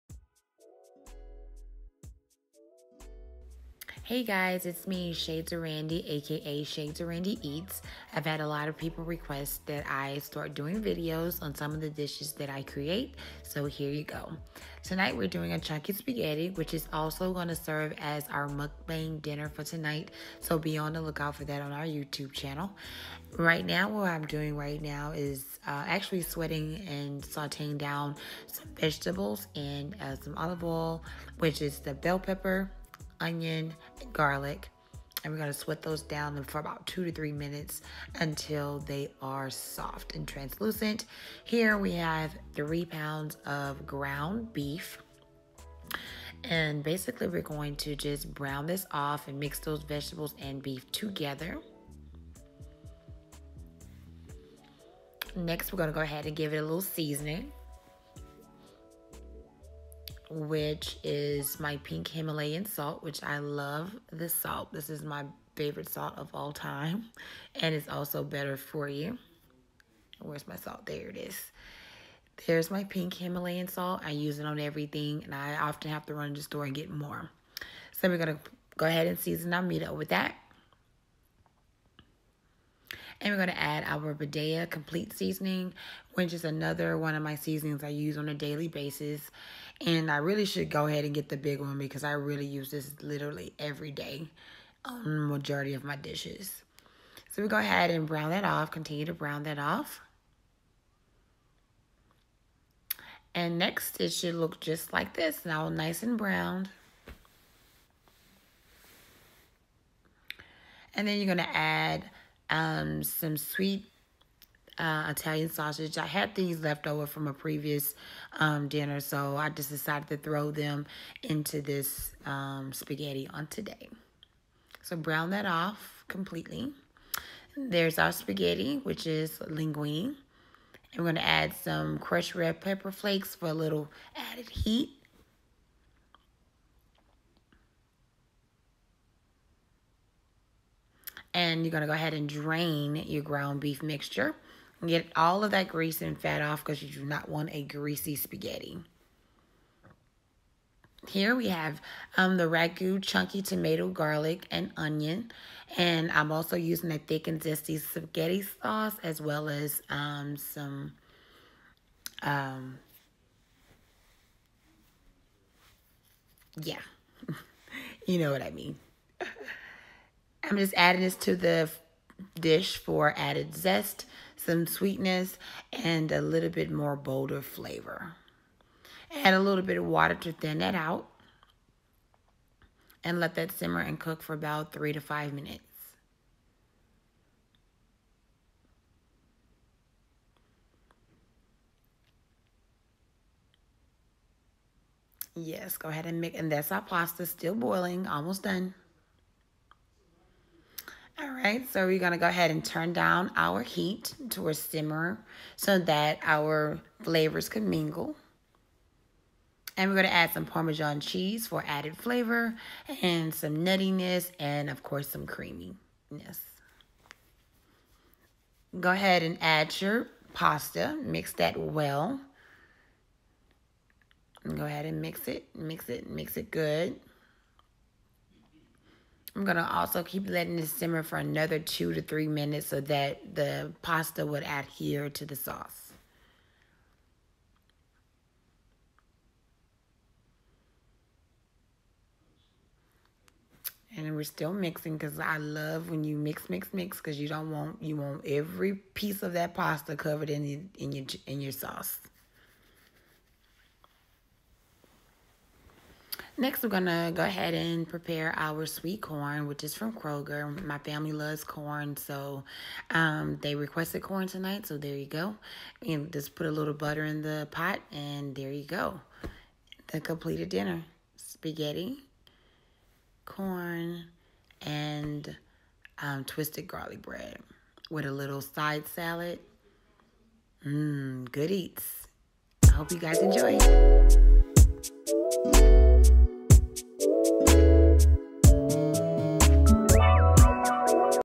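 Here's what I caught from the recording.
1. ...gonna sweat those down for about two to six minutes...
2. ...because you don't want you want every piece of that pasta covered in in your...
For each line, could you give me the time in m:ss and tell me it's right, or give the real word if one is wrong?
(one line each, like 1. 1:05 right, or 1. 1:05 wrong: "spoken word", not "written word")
1. 0:35 wrong: "three", not "six"
2. 4:06 right.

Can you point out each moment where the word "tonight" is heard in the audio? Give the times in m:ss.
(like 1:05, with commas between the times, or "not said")
0:14, 0:19, 4:24.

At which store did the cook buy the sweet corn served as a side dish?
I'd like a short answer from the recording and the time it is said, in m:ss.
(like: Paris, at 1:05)
Kroger, at 4:19.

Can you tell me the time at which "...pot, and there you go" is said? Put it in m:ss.
4:27.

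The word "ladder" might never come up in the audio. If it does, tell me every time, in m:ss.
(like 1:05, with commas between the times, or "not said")
not said.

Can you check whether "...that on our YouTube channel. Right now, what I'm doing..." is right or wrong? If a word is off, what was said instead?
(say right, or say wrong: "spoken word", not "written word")
right.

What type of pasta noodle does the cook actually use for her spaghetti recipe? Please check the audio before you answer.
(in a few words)
Linguine.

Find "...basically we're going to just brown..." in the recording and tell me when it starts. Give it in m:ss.
0:46.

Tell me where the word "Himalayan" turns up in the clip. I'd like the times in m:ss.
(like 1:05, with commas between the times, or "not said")
1:02, 1:13.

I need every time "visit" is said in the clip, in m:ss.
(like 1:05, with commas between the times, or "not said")
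not said.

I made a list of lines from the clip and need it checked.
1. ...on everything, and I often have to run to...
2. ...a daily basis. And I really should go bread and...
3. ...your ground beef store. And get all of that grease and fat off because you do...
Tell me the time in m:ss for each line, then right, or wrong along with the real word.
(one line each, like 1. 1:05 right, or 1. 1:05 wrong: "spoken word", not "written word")
1. 1:14 right
2. 1:28 wrong: "ahead", not "bread"
3. 2:22 wrong: "mixture", not "store".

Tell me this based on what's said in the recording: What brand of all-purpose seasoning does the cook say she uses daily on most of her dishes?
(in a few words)
Badia Complete Seasoning.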